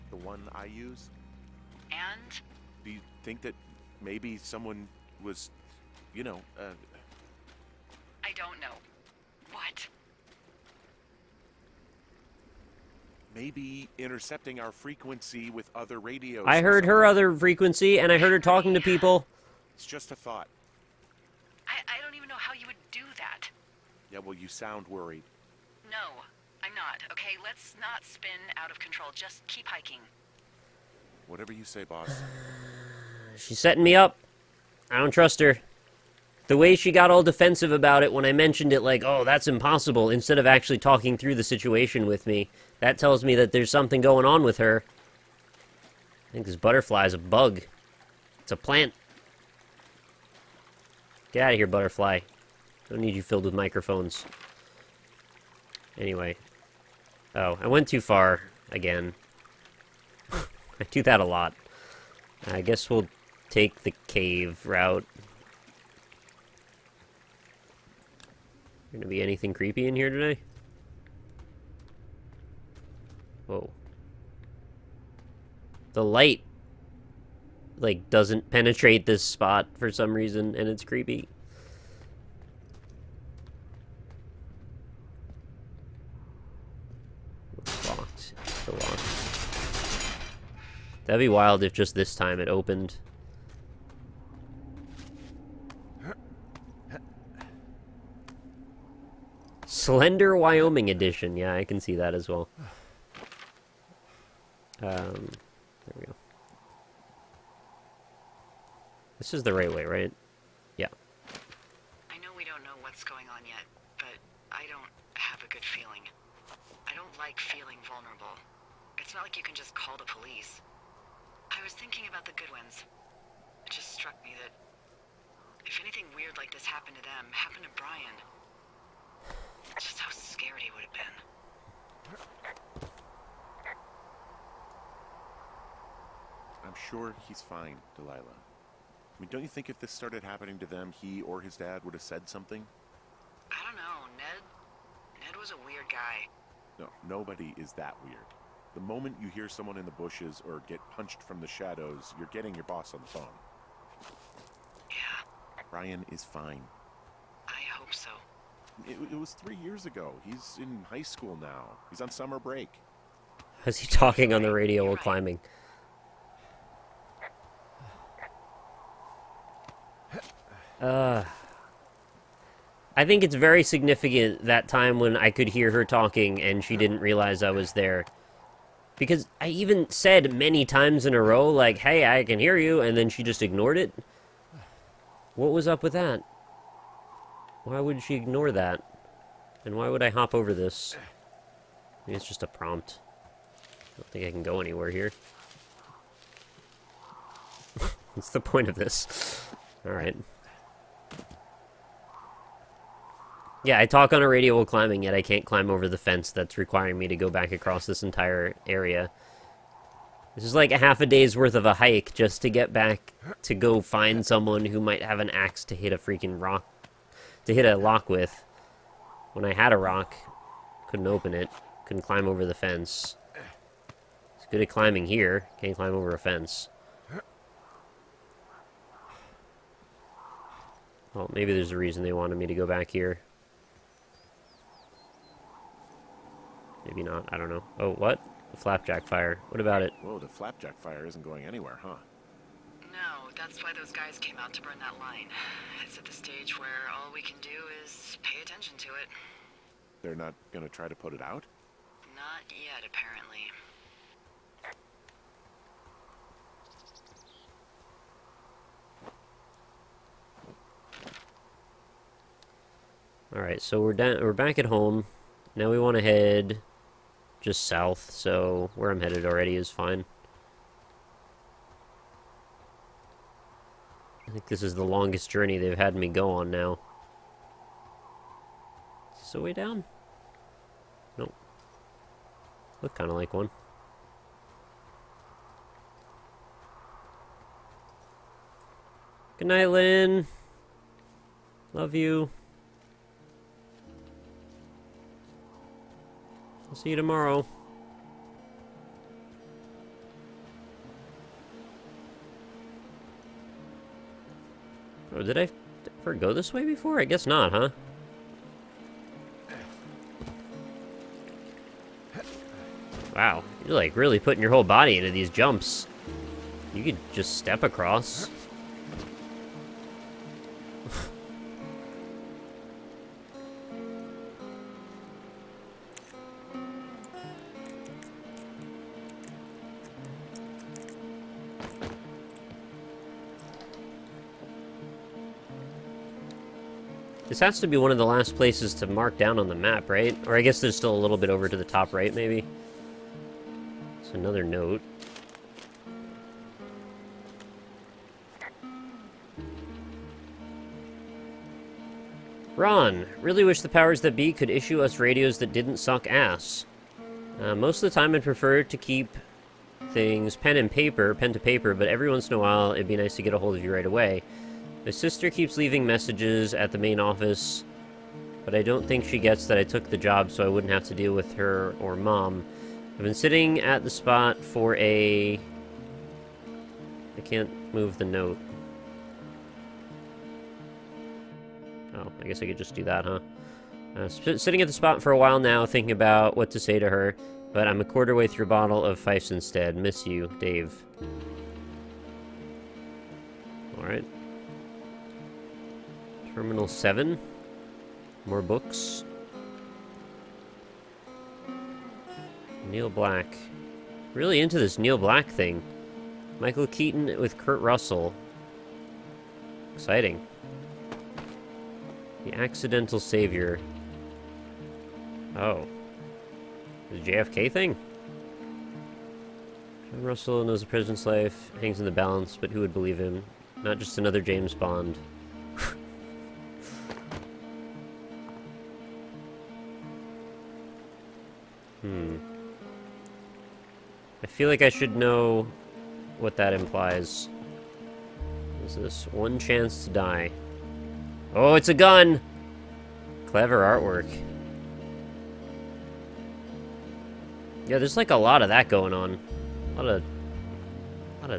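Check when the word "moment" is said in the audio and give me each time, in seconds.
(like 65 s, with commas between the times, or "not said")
148 s.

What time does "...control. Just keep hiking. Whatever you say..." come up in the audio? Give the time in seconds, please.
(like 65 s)
28 s.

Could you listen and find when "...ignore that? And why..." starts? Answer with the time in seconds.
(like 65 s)
188 s.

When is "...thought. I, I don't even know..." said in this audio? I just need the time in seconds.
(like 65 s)
20 s.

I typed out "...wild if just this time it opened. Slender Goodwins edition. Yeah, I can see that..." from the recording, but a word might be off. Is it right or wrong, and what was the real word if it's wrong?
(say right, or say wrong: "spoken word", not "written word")
wrong: "Wyoming", not "Goodwins".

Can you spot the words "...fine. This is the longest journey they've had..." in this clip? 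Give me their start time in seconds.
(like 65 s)
269 s.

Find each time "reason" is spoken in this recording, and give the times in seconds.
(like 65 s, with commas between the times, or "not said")
80 s, 231 s.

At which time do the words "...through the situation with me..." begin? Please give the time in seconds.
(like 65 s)
41 s.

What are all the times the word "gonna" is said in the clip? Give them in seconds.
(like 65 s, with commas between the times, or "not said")
68 s, 250 s.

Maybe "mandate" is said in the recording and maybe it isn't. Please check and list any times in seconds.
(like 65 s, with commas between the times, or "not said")
not said.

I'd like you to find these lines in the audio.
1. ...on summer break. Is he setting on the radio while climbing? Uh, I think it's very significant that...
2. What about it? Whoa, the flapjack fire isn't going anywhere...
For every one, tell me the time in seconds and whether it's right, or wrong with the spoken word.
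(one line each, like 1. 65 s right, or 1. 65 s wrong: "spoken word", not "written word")
1. 162 s wrong: "talking", not "setting"
2. 239 s right.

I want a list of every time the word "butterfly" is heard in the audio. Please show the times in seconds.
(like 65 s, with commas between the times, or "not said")
46 s, 51 s.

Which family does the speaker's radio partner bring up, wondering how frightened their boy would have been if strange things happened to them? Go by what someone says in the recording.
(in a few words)
The Goodwins.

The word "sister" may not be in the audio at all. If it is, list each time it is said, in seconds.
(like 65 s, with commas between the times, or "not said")
364 s.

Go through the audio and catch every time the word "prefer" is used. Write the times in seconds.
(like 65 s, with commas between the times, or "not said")
358 s.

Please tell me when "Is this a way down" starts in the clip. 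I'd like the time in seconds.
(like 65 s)
279 s.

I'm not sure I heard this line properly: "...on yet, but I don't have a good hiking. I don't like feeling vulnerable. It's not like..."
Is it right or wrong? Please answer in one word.
wrong.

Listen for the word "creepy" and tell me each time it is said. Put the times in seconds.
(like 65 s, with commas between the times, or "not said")
69 s, 80 s.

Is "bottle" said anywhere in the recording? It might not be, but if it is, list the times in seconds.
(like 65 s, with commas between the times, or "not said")
388 s.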